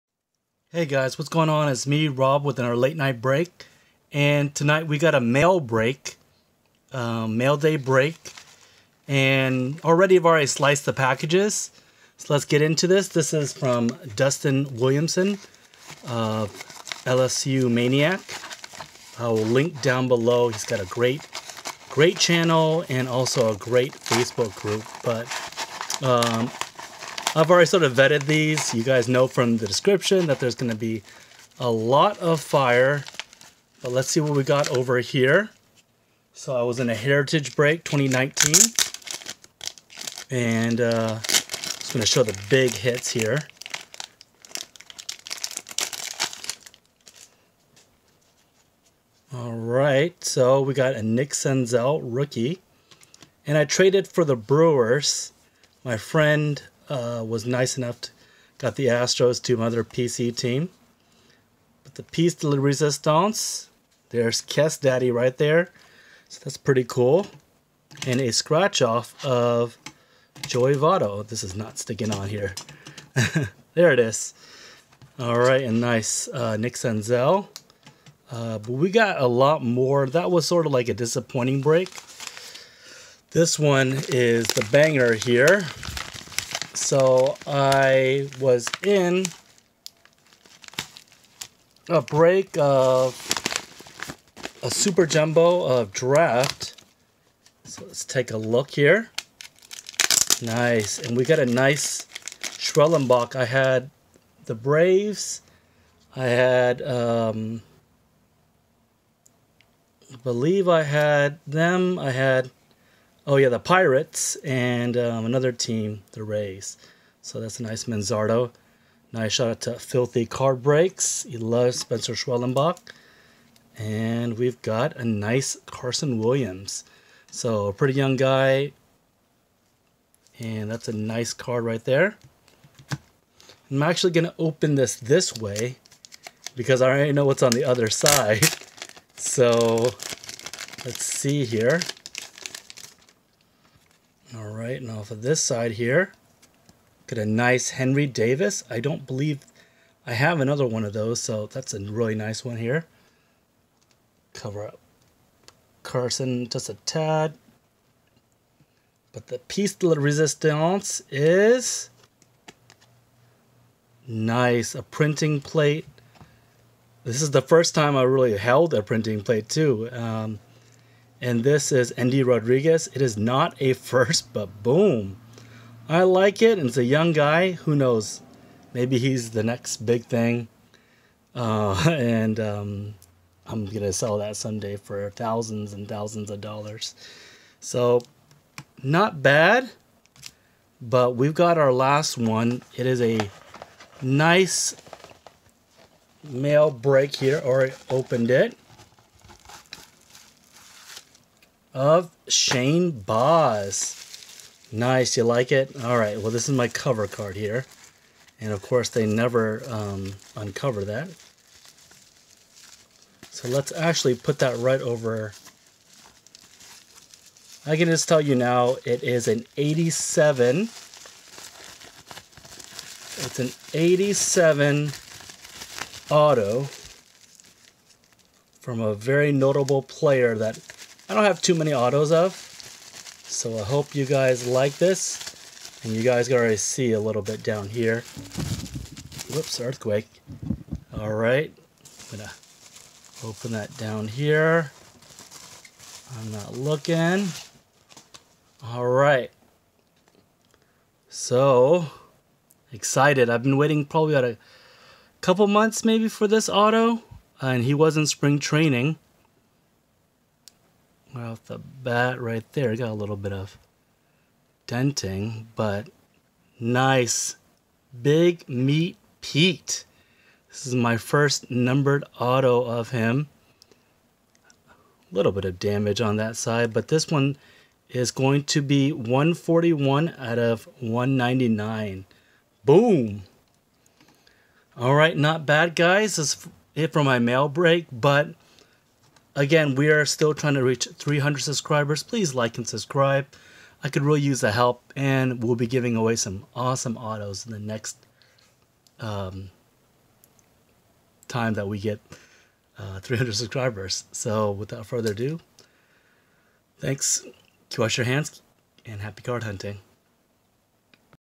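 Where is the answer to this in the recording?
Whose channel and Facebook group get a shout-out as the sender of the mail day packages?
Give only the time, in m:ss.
0:14.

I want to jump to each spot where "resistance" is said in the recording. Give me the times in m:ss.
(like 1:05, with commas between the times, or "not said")
1:02, 2:39.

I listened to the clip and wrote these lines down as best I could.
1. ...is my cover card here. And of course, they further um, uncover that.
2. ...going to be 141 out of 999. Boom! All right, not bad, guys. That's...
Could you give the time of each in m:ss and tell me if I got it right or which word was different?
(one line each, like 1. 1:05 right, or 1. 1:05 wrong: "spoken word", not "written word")
1. 3:26 wrong: "never", not "further"
2. 4:38 wrong: "199", not "999".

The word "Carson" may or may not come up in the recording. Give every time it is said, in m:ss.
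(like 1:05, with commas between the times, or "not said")
2:05, 2:35.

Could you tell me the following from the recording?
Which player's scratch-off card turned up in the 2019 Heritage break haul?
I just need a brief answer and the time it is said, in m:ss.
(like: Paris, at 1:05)
Joey Votto, at 1:10.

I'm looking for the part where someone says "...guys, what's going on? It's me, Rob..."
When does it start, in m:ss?
0:00.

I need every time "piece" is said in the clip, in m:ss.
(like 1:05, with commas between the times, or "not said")
1:02, 2:39.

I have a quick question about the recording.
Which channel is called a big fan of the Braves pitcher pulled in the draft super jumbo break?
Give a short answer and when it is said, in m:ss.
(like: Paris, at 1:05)
Filthy Card Breaks, at 1:59.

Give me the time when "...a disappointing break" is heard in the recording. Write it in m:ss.
1:20.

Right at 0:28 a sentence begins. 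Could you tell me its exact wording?
You guys know from the description that there's gonna be a lot of fire, but let's see what we got over here.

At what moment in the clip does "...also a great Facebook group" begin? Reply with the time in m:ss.
0:23.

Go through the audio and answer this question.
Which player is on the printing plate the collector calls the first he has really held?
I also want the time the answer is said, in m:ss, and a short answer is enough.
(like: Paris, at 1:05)
Endy Rodriguez, at 2:51.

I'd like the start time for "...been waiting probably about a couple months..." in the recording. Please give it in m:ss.
4:13.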